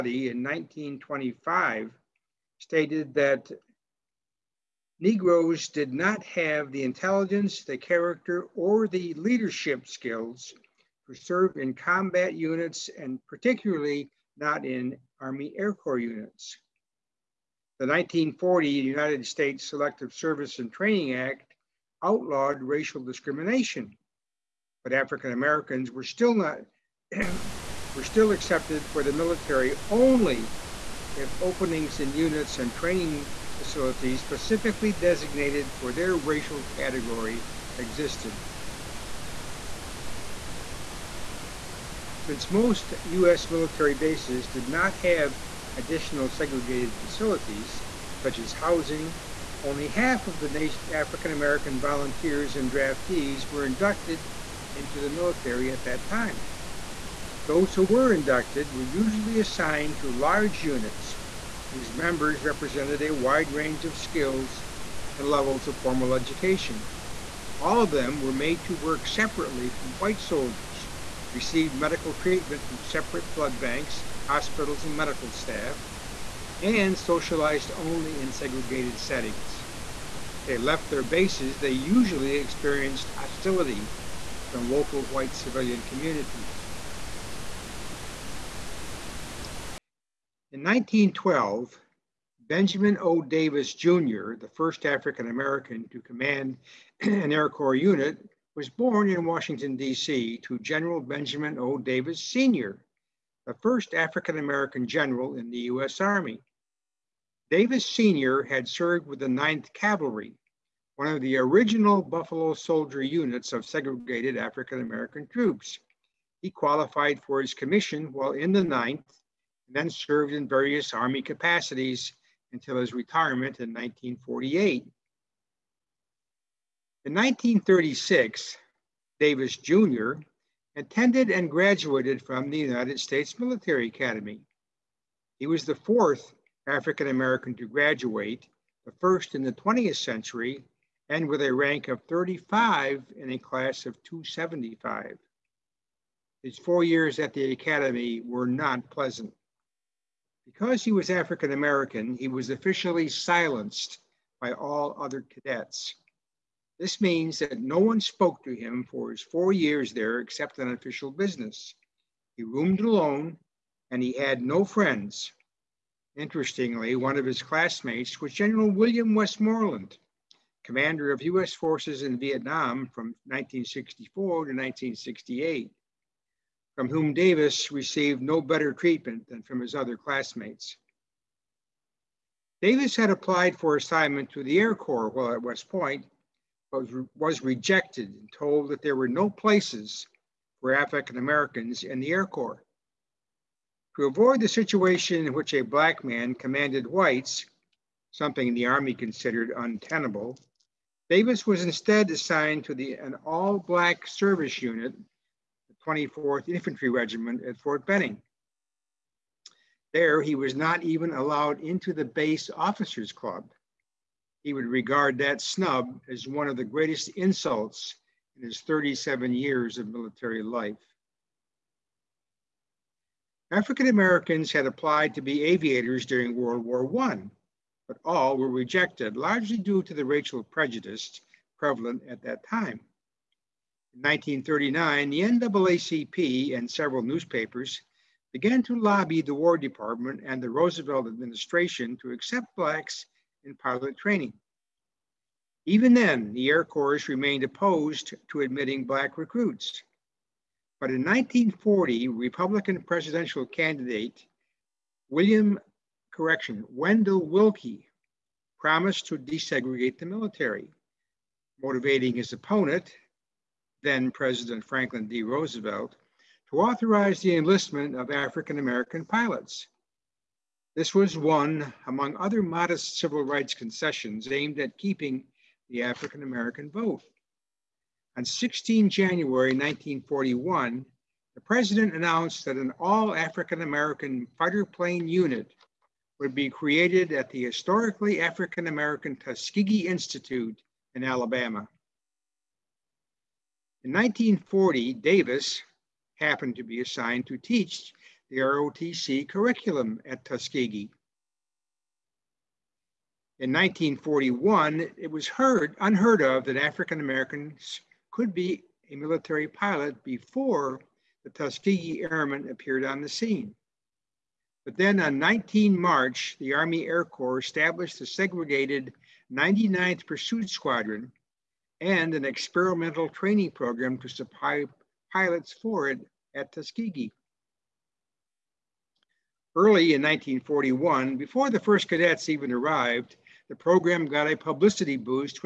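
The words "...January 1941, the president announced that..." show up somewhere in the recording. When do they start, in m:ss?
4:38.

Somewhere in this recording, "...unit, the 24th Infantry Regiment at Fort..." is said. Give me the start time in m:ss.
3:24.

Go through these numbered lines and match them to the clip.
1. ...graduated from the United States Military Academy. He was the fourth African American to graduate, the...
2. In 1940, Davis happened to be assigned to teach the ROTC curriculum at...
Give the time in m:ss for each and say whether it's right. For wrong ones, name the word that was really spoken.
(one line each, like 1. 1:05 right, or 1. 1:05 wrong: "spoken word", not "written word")
1. 2:11 right
2. 4:53 right.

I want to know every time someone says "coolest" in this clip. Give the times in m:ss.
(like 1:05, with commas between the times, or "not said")
not said.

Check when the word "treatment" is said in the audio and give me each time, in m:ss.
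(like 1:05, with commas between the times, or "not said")
1:12, 2:58.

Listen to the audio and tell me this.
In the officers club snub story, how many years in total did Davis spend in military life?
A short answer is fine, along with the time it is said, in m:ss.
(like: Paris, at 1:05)
37, at 3:38.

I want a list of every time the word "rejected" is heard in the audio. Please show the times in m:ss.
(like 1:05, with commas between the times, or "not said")
3:07, 3:48.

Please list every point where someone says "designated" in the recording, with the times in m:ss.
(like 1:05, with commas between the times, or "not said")
0:34.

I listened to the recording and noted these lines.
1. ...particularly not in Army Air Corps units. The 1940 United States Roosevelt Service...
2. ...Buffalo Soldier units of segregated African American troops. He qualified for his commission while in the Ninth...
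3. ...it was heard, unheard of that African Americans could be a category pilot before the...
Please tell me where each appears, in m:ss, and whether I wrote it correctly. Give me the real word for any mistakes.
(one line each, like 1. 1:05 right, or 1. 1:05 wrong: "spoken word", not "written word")
1. 0:13 wrong: "Selective", not "Roosevelt"
2. 1:52 right
3. 5:04 wrong: "military", not "category".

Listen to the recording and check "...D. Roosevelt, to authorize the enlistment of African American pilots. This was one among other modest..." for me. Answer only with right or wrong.
right.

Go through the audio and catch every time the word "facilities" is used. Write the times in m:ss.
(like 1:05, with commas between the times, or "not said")
0:33, 0:46.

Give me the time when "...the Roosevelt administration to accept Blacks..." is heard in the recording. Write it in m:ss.
4:00.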